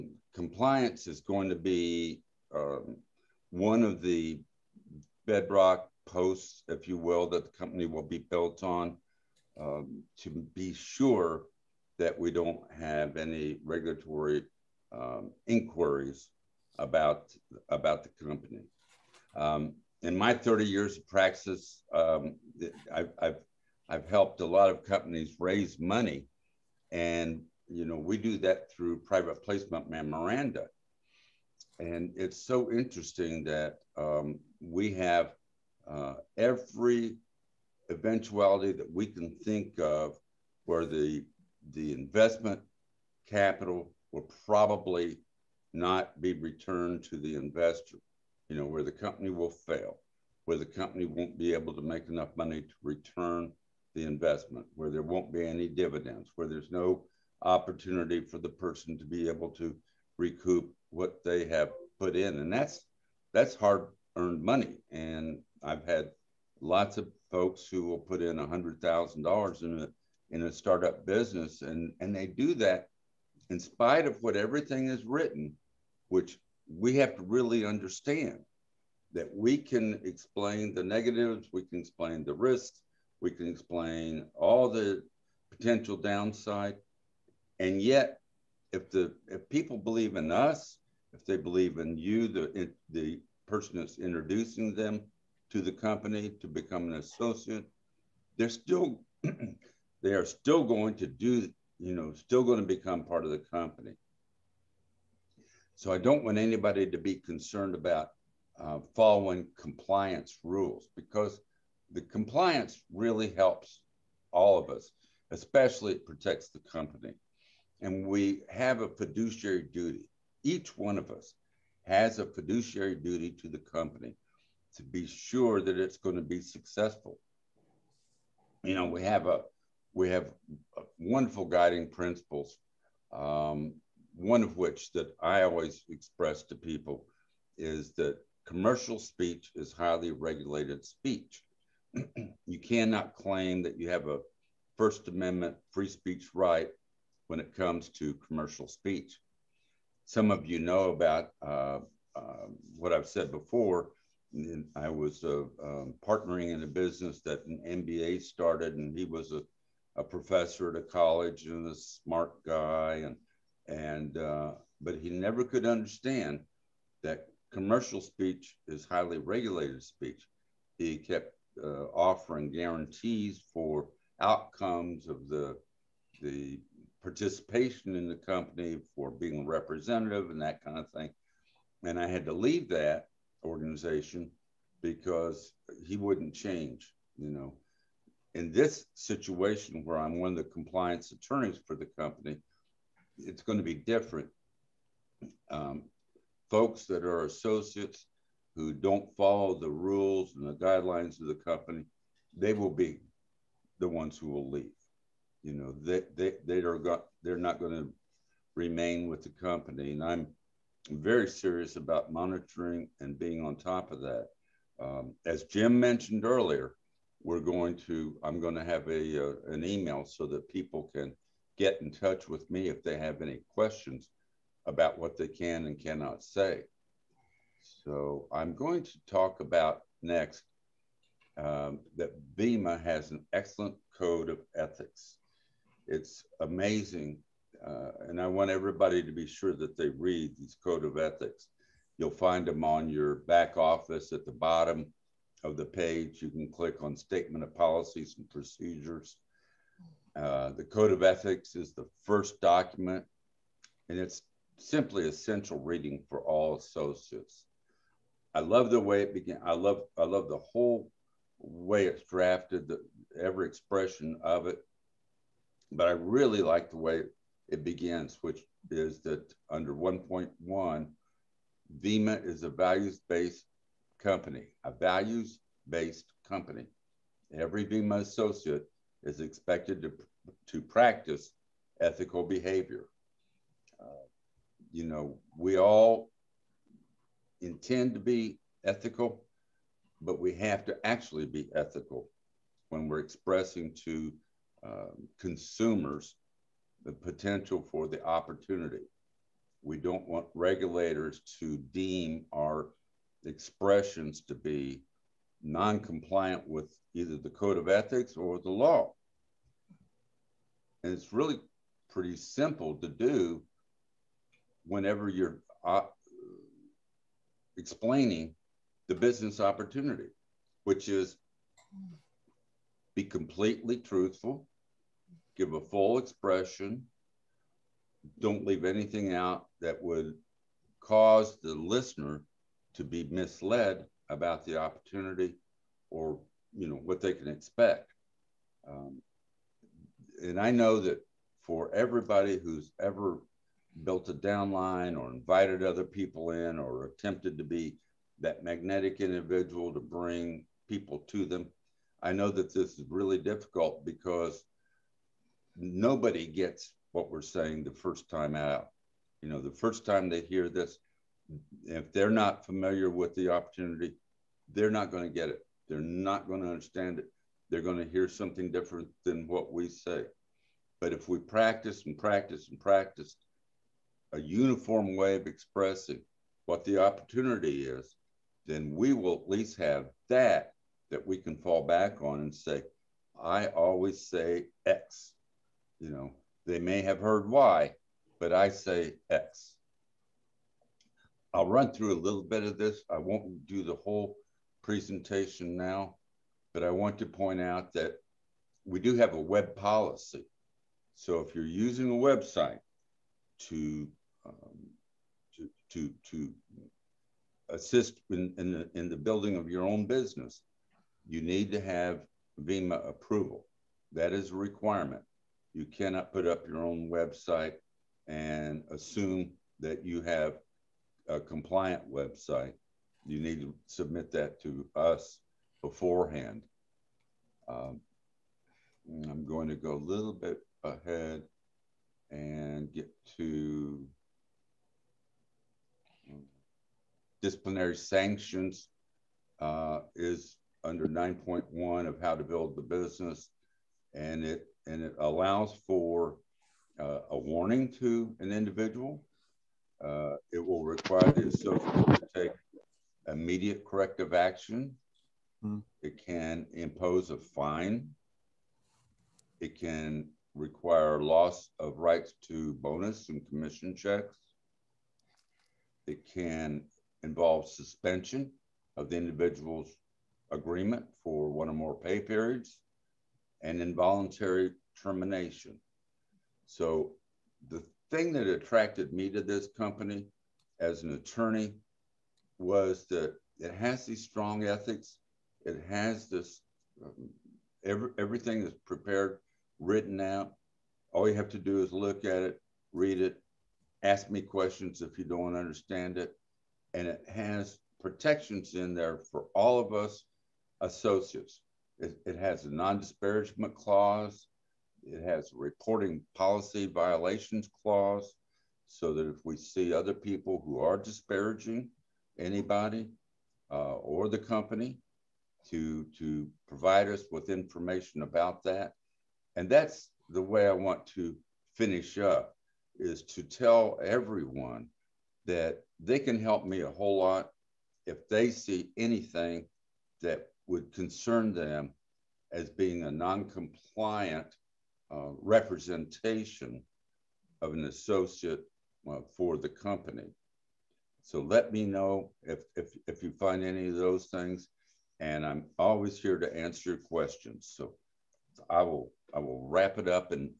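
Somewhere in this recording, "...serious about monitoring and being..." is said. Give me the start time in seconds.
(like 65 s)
211 s.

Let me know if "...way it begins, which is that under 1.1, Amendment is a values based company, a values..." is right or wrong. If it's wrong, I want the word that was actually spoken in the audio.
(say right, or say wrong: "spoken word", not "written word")
wrong: "VIMA", not "Amendment".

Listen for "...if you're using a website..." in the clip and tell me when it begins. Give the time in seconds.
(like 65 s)
401 s.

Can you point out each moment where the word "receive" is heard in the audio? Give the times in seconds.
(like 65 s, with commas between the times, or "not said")
not said.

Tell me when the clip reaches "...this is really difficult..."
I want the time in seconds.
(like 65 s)
352 s.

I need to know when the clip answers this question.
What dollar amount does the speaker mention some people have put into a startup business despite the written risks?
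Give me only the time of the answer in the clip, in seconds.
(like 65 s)
68 s.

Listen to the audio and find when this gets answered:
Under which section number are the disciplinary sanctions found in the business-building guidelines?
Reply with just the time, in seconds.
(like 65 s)
440 s.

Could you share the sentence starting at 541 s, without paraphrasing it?
So let me know if, if, if you find any of those things.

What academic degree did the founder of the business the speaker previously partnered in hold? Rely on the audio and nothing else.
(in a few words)
MBA.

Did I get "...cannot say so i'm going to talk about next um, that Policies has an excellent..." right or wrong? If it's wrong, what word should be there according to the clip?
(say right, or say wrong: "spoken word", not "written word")
wrong: "Vima", not "Policies".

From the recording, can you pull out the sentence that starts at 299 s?
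We don't want regulators to deem our expressions to be non-compliant with either the code of ethics or the law.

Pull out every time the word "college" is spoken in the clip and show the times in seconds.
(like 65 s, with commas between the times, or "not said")
160 s.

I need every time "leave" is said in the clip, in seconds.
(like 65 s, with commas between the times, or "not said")
182 s, 204 s, 328 s.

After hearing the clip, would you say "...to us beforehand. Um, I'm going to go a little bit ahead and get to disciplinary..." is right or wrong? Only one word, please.
right.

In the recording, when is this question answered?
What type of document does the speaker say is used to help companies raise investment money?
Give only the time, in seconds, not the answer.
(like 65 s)
28 s.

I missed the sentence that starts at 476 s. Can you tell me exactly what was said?
So the thing that attracted me to this company as an attorney was that it has these strong ethics.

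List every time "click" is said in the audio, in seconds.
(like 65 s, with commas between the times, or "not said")
246 s.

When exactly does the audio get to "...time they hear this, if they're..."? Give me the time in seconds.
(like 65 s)
359 s.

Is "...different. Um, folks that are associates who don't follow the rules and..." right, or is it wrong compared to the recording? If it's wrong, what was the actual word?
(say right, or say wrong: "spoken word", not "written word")
right.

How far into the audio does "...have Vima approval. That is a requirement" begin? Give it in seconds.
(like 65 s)
411 s.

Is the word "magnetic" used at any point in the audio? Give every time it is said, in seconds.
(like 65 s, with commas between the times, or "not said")
348 s.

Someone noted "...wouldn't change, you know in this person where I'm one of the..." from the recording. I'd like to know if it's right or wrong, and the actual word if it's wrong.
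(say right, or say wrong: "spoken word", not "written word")
wrong: "situation", not "person".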